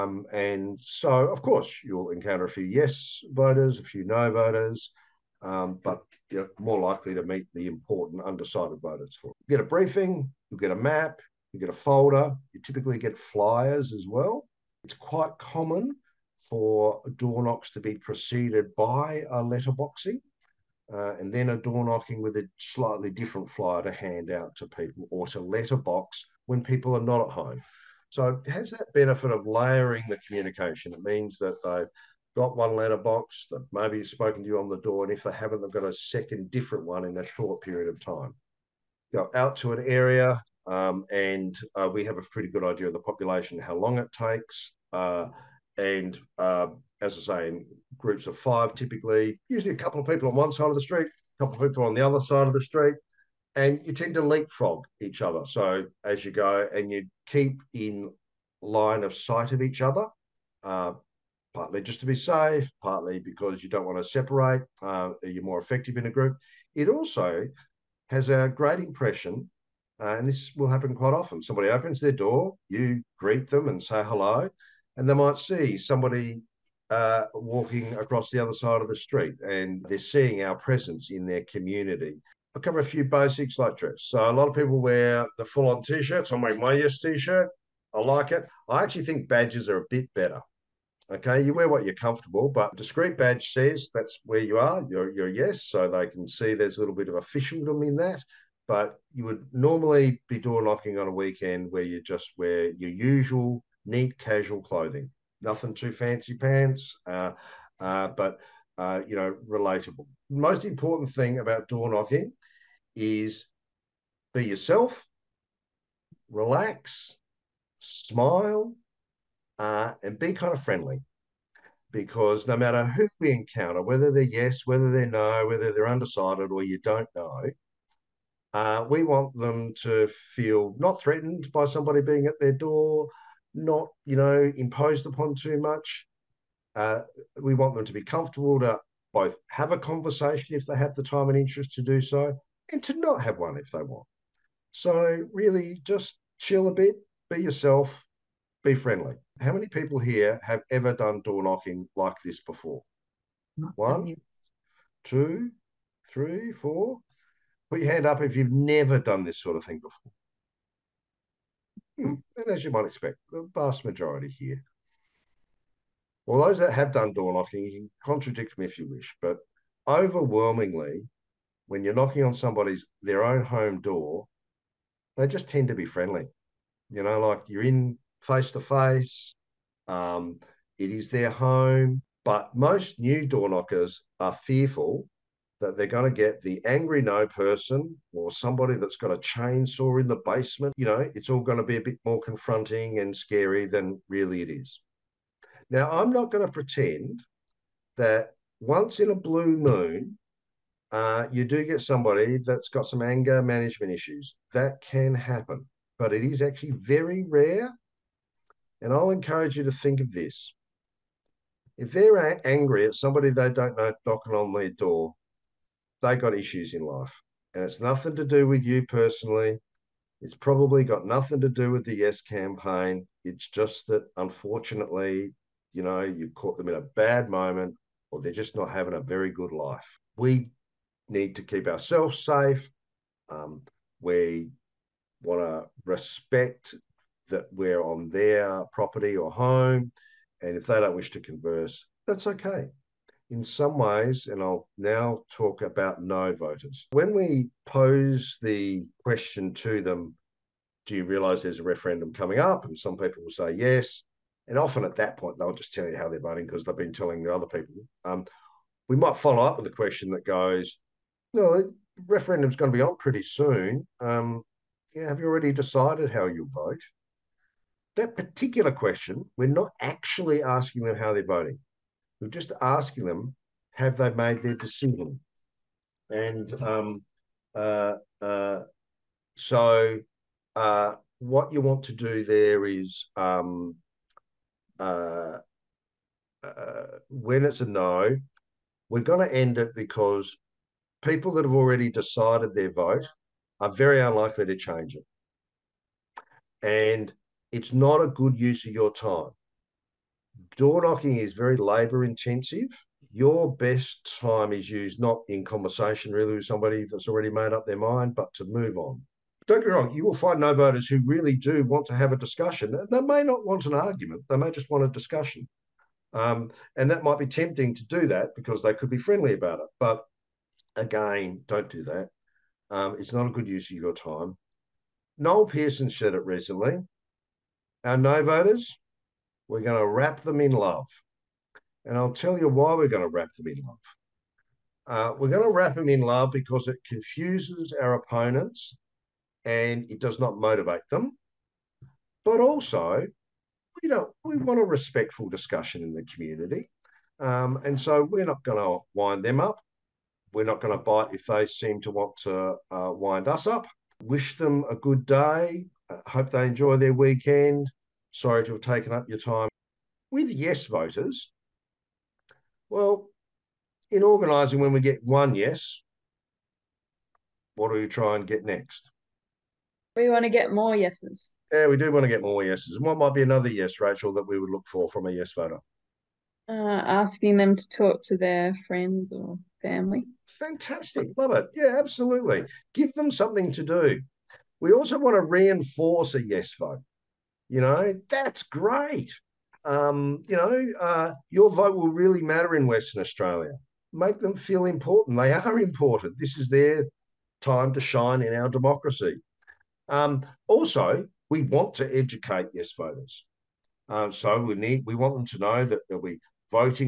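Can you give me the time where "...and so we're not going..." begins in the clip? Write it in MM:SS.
05:47.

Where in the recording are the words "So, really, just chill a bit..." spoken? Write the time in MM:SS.
02:24.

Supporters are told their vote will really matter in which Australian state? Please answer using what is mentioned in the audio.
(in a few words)
Western Australia.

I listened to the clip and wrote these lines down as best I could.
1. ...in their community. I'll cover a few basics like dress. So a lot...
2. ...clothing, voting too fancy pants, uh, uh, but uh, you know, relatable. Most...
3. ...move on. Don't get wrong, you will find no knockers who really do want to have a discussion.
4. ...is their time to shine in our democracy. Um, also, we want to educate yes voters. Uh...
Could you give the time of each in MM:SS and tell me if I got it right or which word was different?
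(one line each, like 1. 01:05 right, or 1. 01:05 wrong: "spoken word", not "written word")
1. 01:21 right
2. 01:44 wrong: "nothing", not "voting"
3. 05:08 wrong: "voters", not "knockers"
4. 06:36 right.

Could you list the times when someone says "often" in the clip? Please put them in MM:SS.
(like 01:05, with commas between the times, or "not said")
01:11, 04:14.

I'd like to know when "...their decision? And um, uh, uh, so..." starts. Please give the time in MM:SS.
04:34.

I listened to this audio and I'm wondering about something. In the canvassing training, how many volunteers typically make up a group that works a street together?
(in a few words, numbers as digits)
5.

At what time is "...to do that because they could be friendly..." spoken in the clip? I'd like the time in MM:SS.
05:17.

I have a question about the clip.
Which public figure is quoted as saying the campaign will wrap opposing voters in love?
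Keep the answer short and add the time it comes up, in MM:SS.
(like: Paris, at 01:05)
Noel Pearson, at 05:25.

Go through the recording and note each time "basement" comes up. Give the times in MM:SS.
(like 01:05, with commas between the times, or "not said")
03:10.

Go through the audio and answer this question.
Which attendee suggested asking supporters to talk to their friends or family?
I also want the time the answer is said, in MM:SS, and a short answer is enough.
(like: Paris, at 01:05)
Rachel, at 06:13.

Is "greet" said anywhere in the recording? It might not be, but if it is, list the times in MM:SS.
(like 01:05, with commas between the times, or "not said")
01:13.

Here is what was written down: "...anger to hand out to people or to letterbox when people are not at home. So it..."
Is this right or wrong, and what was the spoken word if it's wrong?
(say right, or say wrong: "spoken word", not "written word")
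wrong: "flyer", not "anger".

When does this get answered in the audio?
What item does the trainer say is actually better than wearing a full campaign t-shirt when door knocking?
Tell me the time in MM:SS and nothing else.
01:29.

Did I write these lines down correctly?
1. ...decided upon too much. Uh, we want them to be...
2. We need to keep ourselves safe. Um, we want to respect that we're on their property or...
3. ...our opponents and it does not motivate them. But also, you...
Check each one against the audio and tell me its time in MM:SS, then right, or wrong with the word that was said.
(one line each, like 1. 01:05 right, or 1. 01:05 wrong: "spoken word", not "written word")
1. 02:14 wrong: "imposed", not "decided"
2. 03:50 right
3. 05:37 right.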